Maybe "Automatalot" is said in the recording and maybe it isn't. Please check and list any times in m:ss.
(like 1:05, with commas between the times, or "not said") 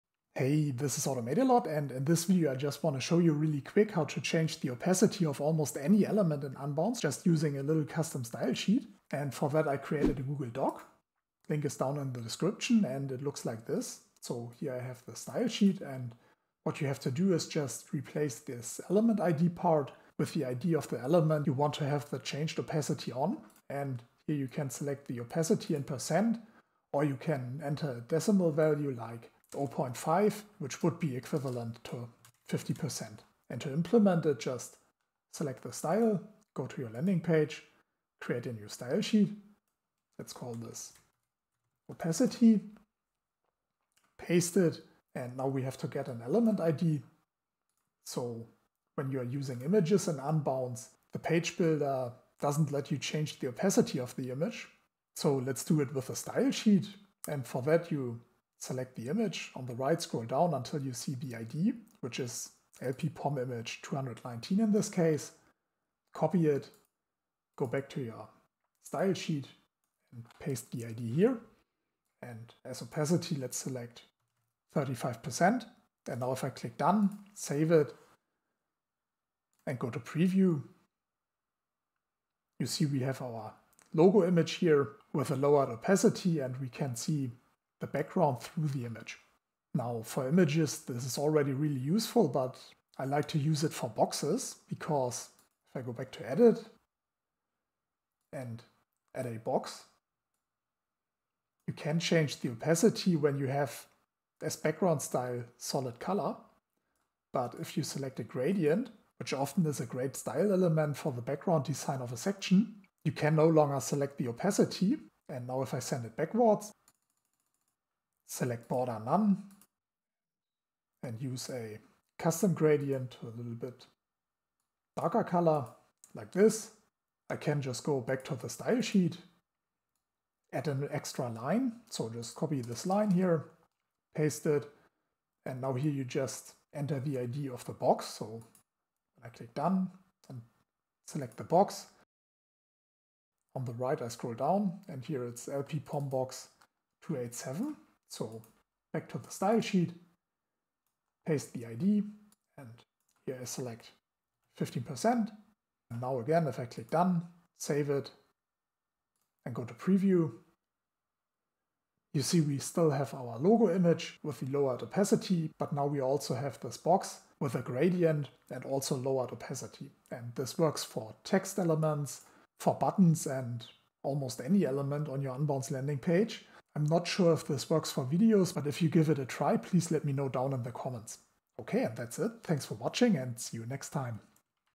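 0:01.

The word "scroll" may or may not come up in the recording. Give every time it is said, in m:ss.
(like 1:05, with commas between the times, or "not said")
1:00, 2:24.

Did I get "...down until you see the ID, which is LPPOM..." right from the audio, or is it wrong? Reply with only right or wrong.
right.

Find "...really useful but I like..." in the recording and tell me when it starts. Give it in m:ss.
1:31.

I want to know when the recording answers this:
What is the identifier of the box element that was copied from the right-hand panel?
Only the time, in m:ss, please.
2:25.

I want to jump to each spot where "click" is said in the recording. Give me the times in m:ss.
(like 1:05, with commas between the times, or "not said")
1:16, 2:19, 2:36.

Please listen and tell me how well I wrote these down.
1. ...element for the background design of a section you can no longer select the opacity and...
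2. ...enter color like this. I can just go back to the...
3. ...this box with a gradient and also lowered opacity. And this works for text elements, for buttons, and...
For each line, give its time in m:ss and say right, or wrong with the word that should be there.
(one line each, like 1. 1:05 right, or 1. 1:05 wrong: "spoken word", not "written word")
1. 1:50 right
2. 2:04 wrong: "darker", not "enter"
3. 2:46 right.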